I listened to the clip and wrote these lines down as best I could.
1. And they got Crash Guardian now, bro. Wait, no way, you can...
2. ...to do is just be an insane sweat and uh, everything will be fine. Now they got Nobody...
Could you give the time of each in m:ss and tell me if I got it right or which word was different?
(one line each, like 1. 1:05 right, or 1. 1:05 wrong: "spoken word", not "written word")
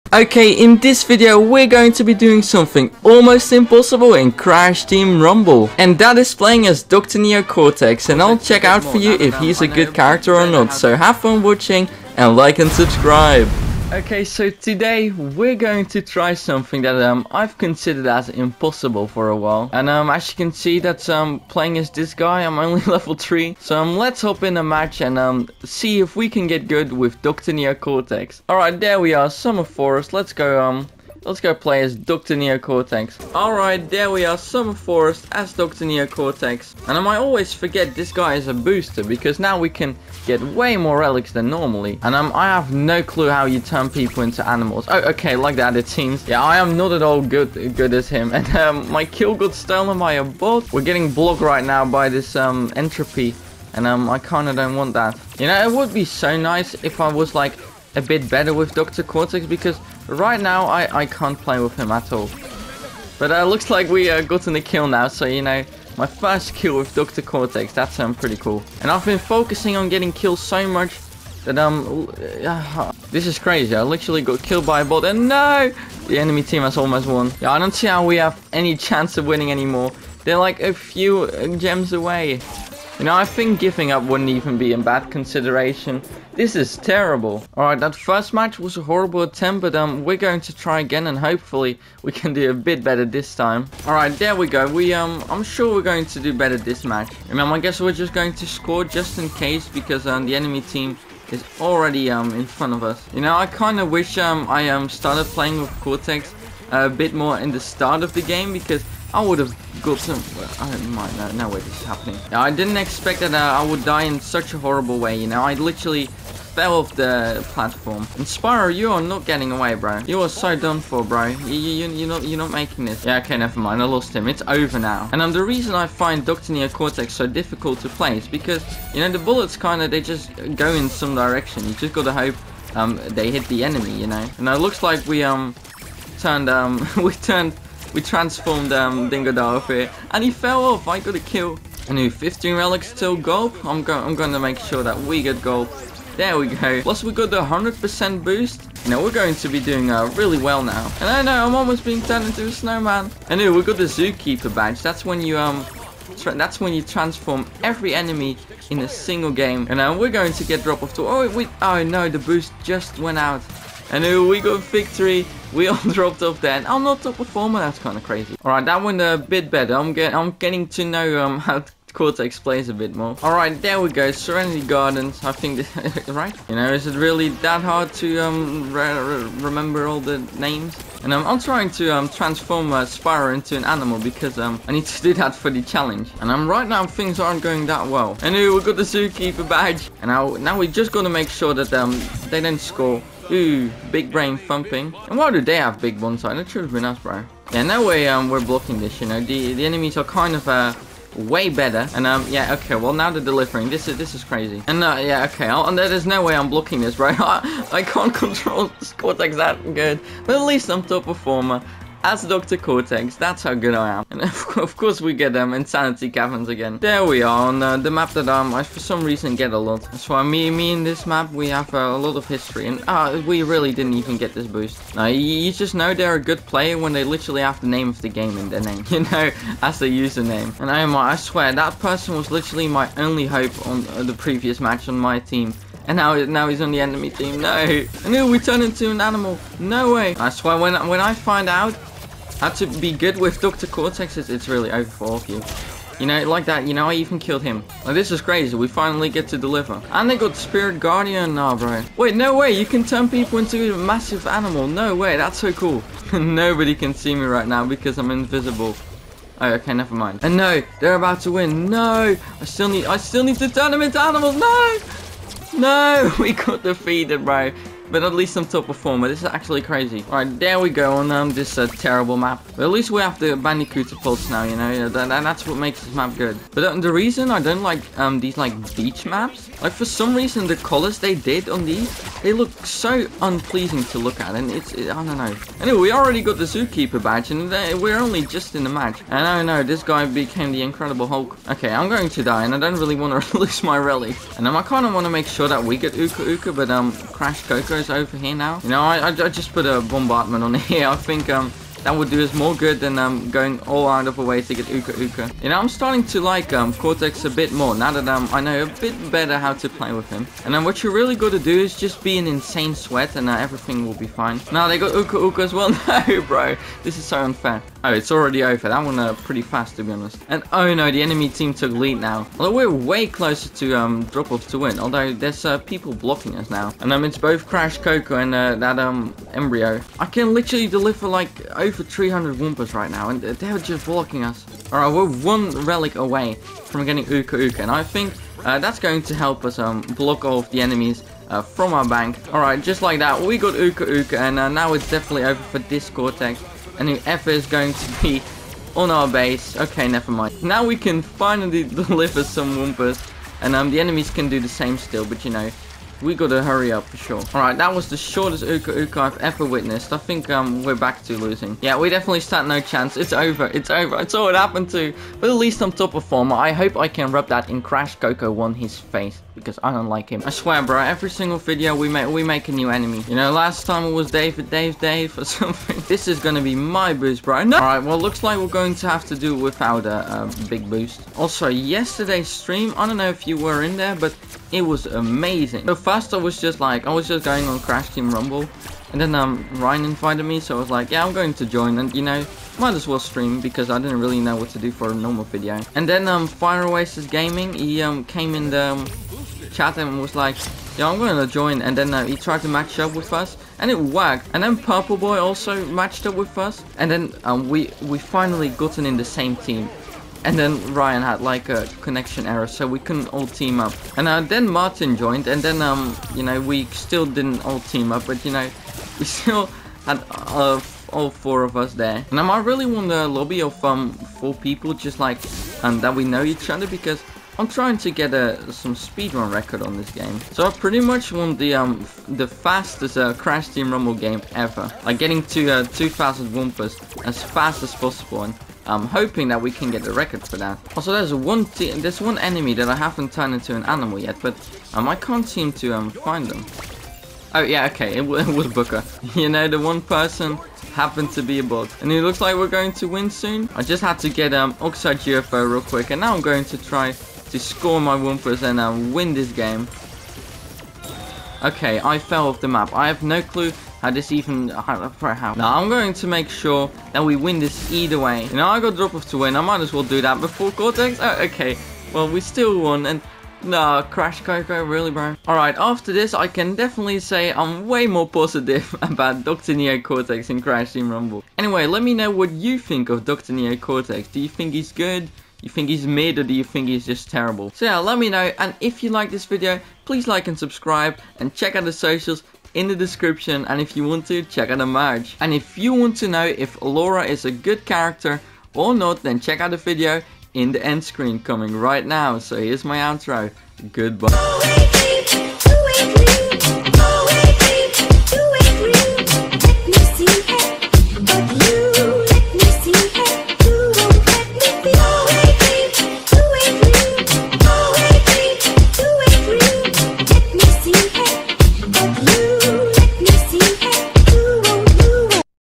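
1. 4:09 wrong: "Spirit", not "Crash"
2. 5:11 wrong: "Uka", not "Nobody".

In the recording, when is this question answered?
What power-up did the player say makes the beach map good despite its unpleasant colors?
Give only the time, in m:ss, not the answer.
4:33.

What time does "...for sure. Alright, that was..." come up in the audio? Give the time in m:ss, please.
5:56.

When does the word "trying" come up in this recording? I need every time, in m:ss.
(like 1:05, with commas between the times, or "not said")
3:01, 7:07.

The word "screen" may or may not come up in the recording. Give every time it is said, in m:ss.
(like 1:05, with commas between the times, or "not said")
8:20.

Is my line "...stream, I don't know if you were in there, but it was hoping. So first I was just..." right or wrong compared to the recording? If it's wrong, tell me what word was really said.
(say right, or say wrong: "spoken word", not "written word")
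wrong: "amazing", not "hoping".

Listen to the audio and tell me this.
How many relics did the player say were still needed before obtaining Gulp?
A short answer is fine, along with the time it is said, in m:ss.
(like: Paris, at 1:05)
15, at 2:22.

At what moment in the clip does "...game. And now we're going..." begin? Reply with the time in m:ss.
2:39.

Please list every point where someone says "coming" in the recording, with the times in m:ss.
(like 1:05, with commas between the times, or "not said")
8:21.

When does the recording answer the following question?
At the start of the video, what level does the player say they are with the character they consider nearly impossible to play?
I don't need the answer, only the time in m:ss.
0:22.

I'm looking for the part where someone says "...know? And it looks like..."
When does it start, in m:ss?
2:14.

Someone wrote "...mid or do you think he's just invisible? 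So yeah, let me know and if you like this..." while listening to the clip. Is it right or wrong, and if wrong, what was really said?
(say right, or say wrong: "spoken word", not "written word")
wrong: "terrible", not "invisible".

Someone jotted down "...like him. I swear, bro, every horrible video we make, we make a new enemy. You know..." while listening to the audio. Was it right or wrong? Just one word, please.
wrong.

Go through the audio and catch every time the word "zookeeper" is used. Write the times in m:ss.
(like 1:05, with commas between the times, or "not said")
2:33, 3:08, 4:46.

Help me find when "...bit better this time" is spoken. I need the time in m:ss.
1:32.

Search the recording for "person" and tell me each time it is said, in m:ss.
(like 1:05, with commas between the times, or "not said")
3:51, 7:29.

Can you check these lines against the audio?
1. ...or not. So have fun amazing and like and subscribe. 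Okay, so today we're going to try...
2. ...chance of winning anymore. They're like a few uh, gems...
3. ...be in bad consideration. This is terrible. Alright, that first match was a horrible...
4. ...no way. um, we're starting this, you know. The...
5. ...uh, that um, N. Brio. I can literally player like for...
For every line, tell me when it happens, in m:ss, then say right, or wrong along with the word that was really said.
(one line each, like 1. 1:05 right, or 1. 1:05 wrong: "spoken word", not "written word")
1. 0:10 wrong: "watching", not "amazing"
2. 1:18 right
3. 1:24 right
4. 3:17 wrong: "blocking", not "starting"
5. 5:28 wrong: "deliver", not "player".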